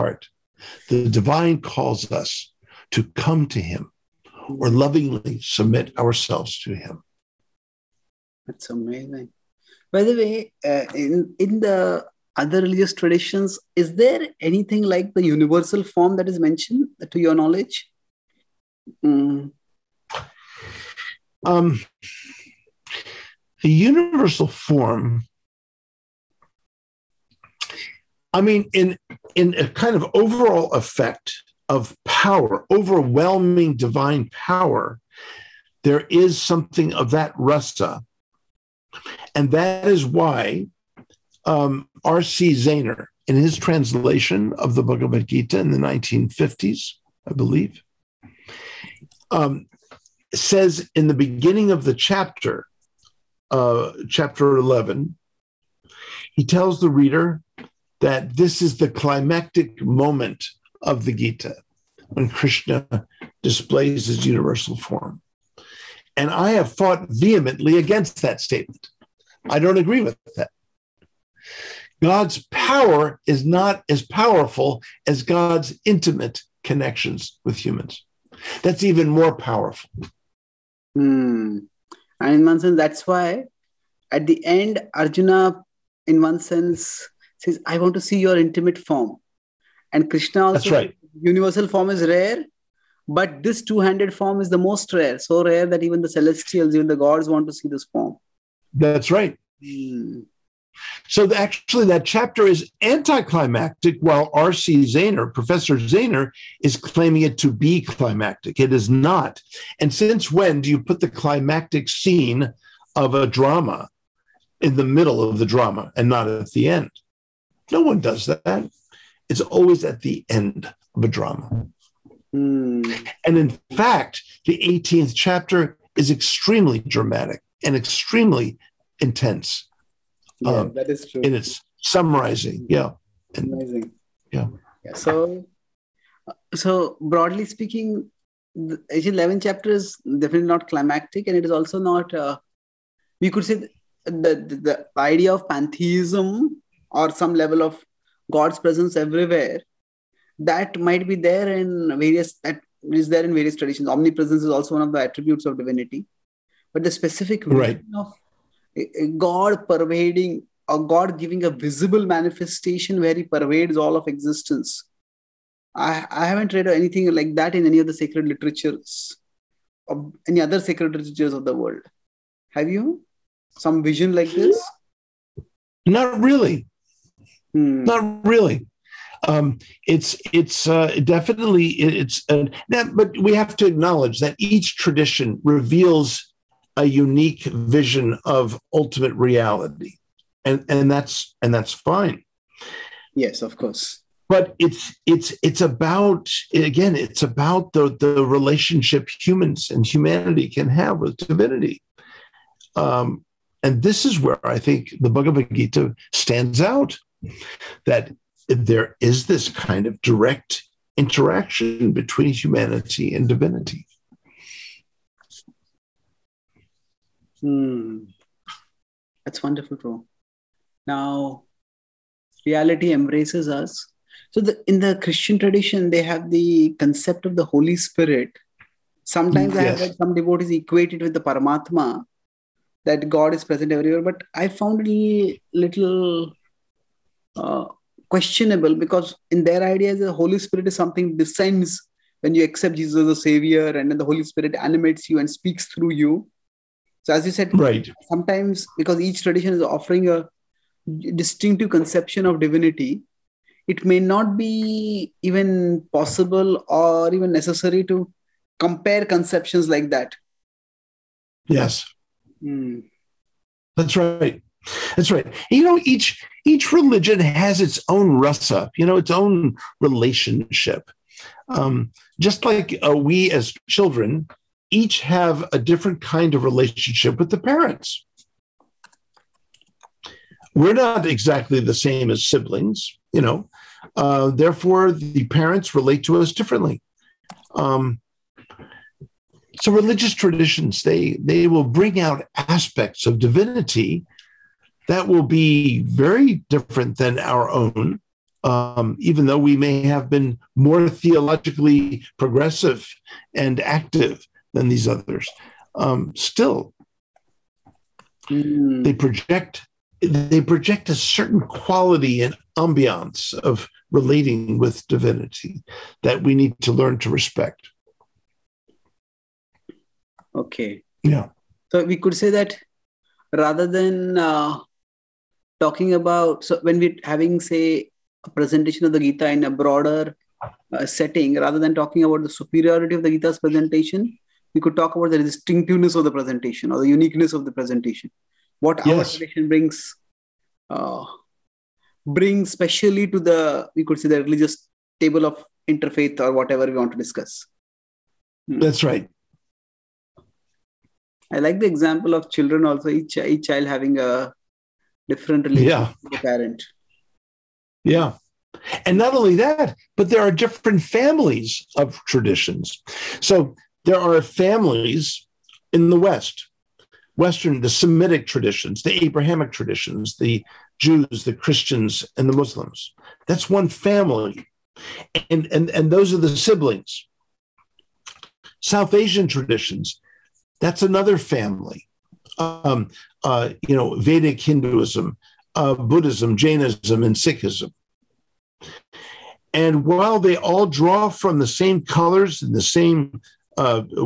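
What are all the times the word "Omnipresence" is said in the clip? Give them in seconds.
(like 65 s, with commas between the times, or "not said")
153 s.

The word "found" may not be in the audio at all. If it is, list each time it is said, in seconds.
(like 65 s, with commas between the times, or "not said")
234 s.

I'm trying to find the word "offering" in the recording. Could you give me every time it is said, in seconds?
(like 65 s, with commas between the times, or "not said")
249 s.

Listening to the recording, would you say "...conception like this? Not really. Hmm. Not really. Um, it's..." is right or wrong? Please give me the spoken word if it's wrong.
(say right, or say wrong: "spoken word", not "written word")
wrong: "vision", not "conception".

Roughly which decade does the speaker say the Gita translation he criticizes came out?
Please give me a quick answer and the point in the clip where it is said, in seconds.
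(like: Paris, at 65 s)
1950s, at 45 s.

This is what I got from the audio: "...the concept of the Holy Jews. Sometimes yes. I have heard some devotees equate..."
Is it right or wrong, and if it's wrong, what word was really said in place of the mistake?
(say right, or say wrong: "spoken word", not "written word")
wrong: "Spirit", not "Jews".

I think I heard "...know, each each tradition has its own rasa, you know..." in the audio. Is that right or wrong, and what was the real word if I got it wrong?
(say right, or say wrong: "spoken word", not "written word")
wrong: "religion", not "tradition".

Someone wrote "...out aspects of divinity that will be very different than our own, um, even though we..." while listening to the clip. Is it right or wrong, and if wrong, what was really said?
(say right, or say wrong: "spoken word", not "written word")
right.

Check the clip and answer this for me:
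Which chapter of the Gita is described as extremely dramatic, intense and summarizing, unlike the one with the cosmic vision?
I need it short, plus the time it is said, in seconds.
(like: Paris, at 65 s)
18th chapter, at 124 s.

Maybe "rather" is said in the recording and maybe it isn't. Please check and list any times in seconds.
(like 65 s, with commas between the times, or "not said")
323 s, 331 s.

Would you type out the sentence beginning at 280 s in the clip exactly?
We're not exactly the same as siblings, you know.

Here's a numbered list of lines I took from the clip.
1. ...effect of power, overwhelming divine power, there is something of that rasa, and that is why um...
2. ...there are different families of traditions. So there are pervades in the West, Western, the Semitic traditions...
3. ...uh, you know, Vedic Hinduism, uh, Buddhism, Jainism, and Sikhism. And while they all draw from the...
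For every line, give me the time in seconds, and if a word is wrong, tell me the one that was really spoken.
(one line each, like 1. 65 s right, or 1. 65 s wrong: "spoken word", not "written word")
1. 30 s right
2. 360 s wrong: "families", not "pervades"
3. 383 s right.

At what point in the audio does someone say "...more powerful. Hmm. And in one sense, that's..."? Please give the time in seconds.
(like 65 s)
79 s.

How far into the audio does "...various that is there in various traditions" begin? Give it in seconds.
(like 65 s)
151 s.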